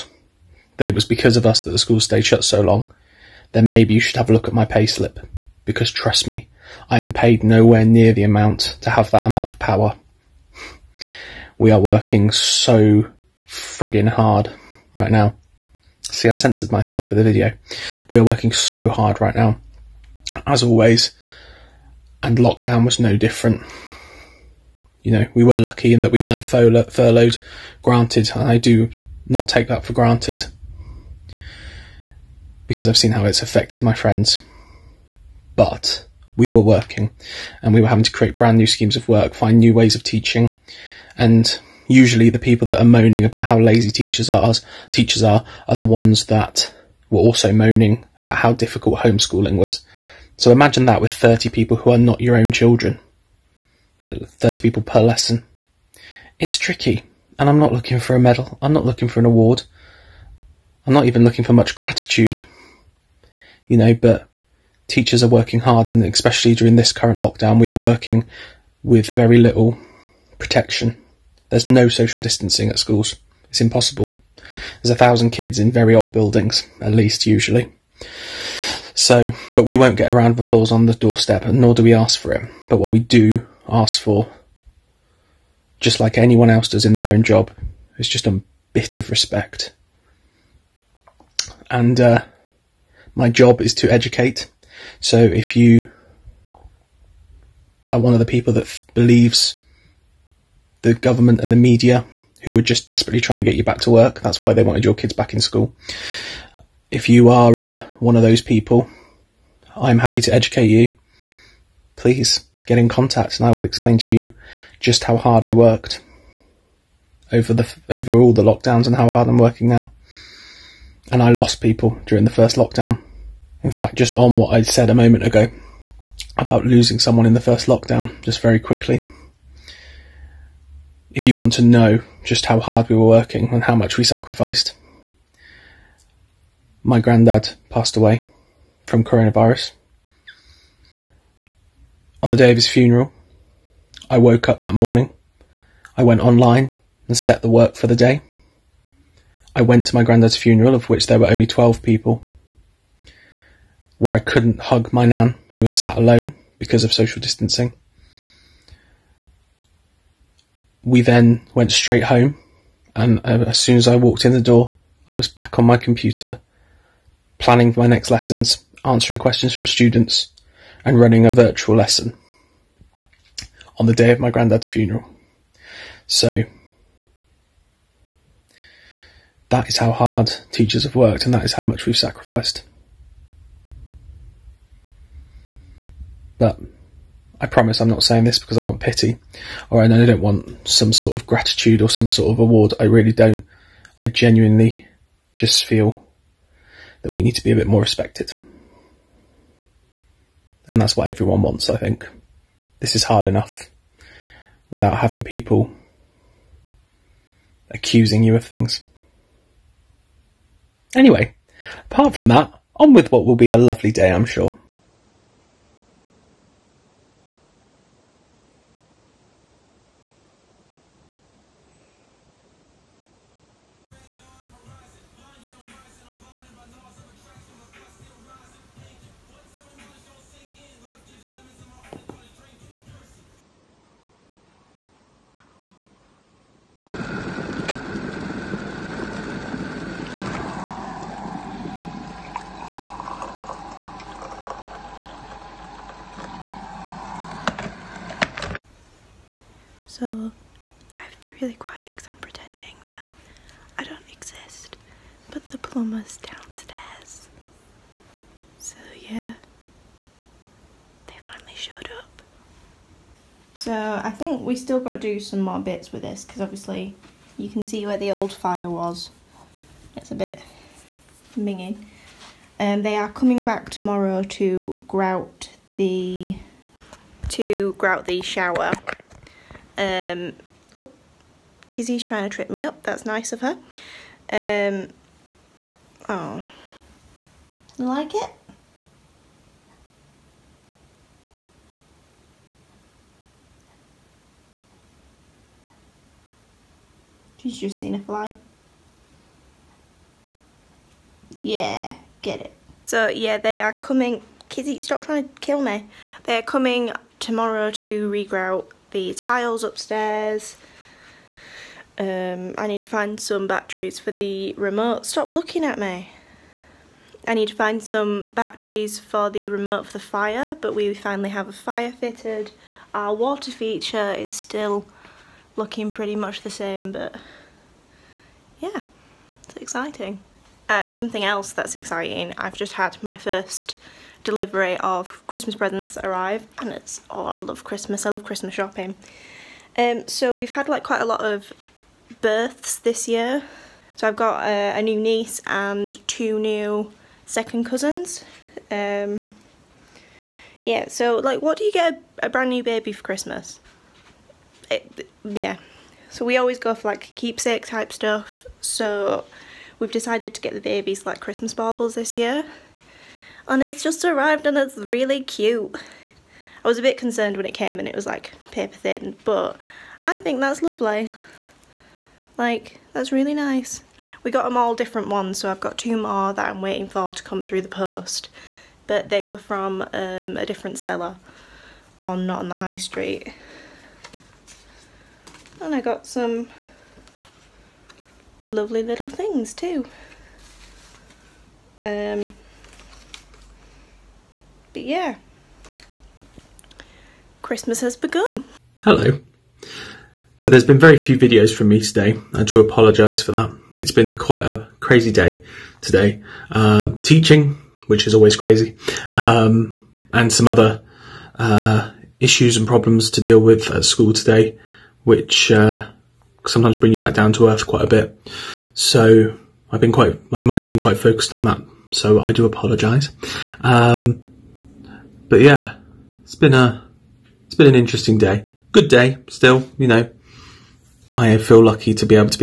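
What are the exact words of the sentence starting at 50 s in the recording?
So imagine that with 30 people who are not your own children.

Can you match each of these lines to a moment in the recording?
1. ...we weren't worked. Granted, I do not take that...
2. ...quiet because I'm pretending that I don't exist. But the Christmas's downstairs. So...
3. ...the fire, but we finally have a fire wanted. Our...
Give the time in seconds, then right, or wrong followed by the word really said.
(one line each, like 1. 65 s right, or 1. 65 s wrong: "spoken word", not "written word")
1. 26 s wrong: "furloughed", not "worked"
2. 251 s wrong: "Pluma", not "Christmas"
3. 319 s wrong: "fitted", not "wanted".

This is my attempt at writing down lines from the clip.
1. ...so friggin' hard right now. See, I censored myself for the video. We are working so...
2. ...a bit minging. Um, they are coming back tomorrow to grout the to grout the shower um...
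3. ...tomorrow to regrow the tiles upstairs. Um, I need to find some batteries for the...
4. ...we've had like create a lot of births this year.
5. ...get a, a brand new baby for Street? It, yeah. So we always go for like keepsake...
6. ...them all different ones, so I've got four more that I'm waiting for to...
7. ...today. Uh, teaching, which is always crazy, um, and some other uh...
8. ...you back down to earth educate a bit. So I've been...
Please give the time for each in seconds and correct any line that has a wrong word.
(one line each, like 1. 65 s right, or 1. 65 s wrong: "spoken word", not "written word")
1. 12 s right
2. 270 s right
3. 307 s right
4. 340 s wrong: "quite", not "create"
5. 351 s wrong: "Christmas", not "Street"
6. 374 s wrong: "two", not "four"
7. 405 s right
8. 416 s wrong: "quite", not "educate".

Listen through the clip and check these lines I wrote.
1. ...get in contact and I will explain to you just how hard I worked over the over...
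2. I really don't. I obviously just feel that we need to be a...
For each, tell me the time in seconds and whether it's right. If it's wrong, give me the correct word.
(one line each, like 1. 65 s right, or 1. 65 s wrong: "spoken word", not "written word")
1. 112 s right
2. 192 s wrong: "genuinely", not "obviously".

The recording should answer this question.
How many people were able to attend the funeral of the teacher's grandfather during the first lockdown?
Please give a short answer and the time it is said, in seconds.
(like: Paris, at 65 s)
12, at 151 s.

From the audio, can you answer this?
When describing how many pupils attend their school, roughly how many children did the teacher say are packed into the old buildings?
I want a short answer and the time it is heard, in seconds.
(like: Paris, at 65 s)
1000, at 74 s.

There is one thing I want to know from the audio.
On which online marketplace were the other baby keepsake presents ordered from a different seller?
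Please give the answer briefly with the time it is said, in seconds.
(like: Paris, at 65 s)
Not on the High Street, at 382 s.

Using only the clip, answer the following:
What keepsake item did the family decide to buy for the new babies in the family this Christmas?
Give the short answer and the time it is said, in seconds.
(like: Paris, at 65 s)
Christmas baubles, at 361 s.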